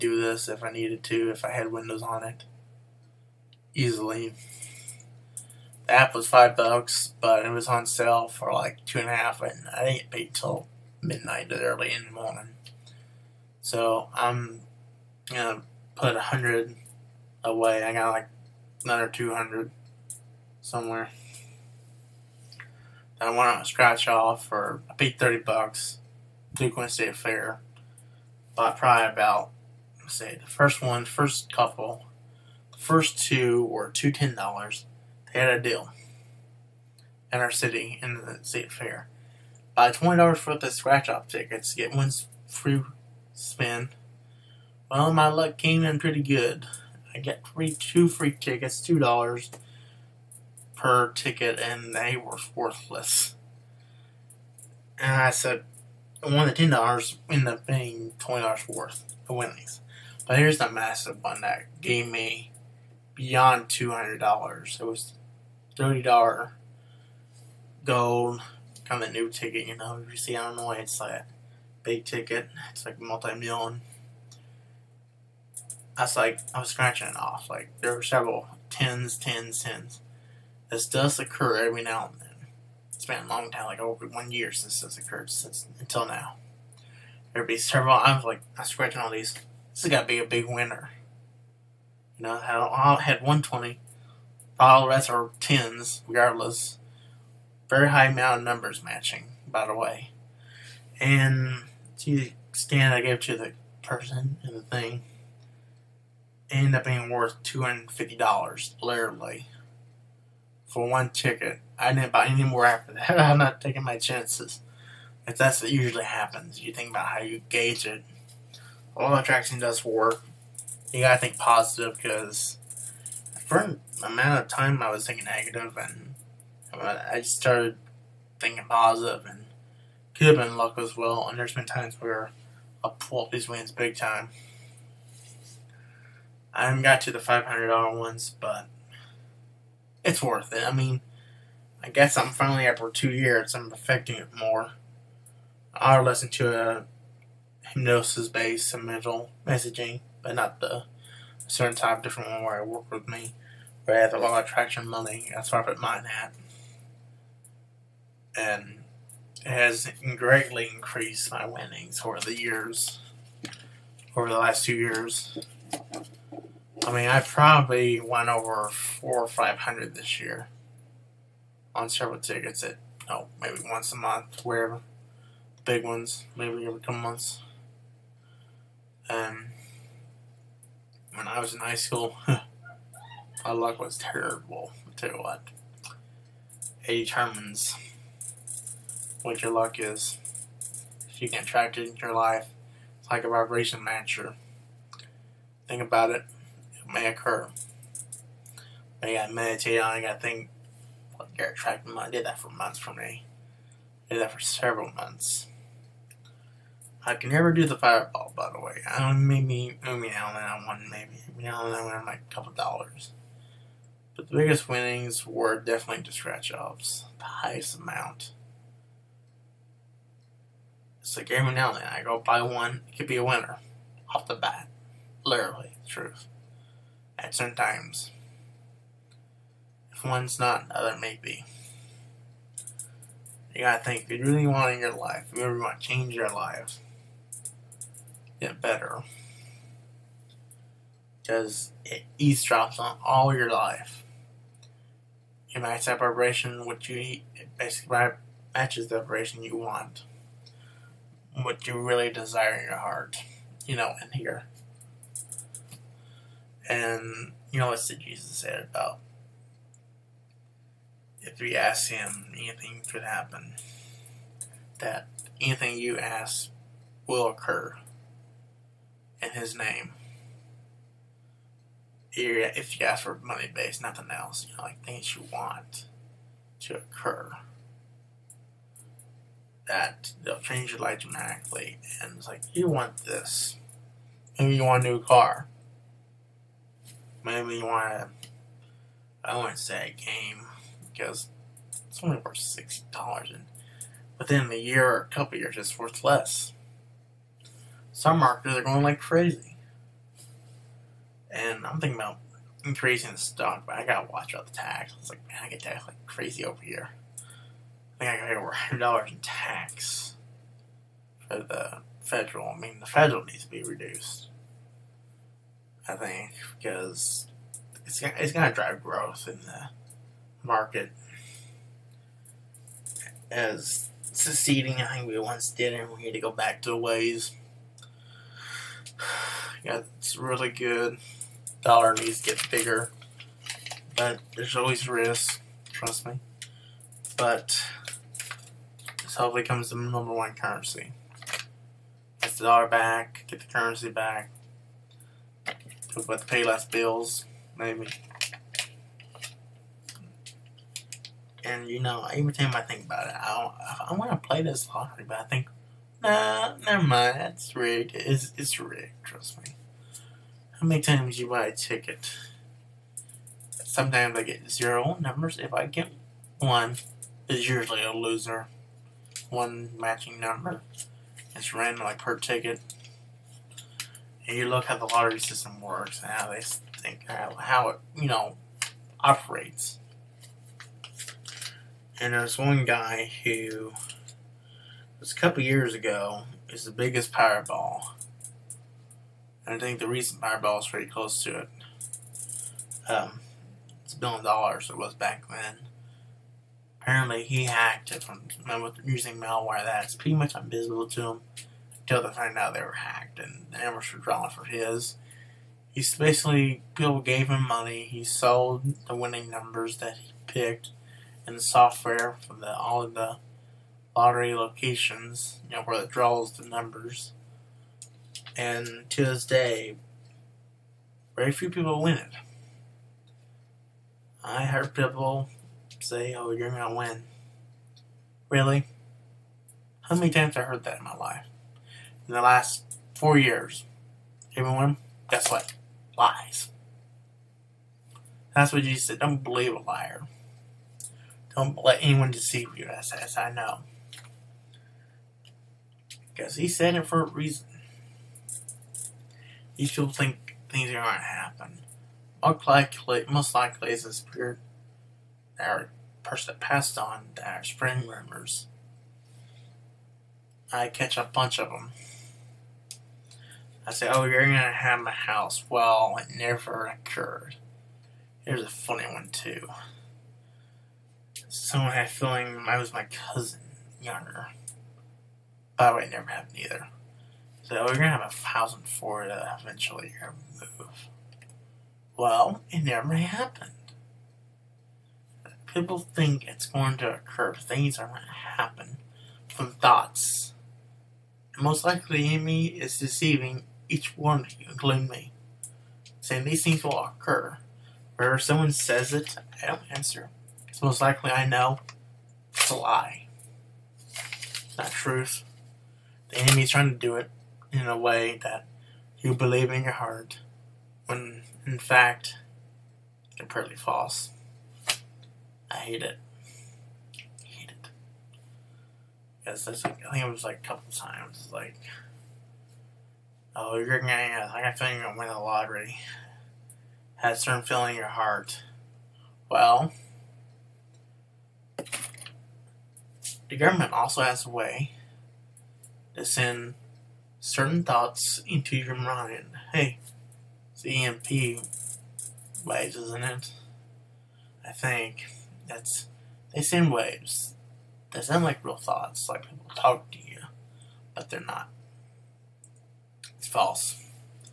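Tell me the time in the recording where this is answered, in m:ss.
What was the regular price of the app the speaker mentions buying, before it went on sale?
0:06.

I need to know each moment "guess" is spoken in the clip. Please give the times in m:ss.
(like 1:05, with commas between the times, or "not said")
2:21, 7:15.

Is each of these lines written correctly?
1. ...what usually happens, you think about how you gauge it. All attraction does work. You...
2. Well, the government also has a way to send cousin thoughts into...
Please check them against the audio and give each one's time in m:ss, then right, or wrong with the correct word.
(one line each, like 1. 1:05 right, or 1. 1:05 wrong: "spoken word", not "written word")
1. 1:55 right
2. 8:49 wrong: "certain", not "cousin".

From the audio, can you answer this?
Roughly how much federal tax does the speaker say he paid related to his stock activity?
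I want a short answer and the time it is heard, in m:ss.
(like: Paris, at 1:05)
over $100, at 5:08.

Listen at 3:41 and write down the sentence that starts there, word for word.
It's like of now and then I go buy one, it could be a winner off the bat.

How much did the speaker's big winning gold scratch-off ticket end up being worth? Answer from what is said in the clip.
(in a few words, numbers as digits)
$250.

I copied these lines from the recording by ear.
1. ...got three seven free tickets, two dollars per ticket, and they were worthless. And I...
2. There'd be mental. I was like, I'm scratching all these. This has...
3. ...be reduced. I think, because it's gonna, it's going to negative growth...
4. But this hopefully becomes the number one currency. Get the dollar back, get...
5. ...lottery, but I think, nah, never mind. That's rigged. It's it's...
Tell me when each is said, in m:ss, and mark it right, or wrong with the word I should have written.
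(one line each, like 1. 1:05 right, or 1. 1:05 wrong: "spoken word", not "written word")
1. 0:47 wrong: "two", not "seven"
2. 1:27 wrong: "several", not "mental"
3. 5:13 wrong: "drive", not "negative"
4. 5:37 right
5. 5:54 right.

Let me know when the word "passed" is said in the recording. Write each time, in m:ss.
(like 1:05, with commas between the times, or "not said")
7:36.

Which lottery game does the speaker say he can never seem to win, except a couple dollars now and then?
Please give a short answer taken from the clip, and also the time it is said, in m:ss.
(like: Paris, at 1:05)
Fireball, at 3:27.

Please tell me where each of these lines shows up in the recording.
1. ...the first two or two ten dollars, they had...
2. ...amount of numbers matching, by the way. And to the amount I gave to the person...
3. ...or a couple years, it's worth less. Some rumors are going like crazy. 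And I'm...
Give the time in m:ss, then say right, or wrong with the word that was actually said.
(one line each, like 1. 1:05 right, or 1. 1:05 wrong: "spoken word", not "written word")
1. 0:32 right
2. 1:38 wrong: "extent", not "amount"
3. 4:54 wrong: "marketers", not "rumors".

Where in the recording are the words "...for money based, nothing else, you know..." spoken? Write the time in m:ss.
4:33.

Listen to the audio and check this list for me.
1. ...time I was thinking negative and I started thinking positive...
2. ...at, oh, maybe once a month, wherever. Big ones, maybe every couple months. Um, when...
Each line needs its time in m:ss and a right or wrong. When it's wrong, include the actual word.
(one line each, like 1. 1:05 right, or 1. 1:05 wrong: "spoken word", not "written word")
1. 2:04 right
2. 2:52 right.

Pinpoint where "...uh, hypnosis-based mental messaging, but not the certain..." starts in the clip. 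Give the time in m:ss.
2:26.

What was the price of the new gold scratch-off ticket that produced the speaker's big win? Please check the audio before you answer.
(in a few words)
$30.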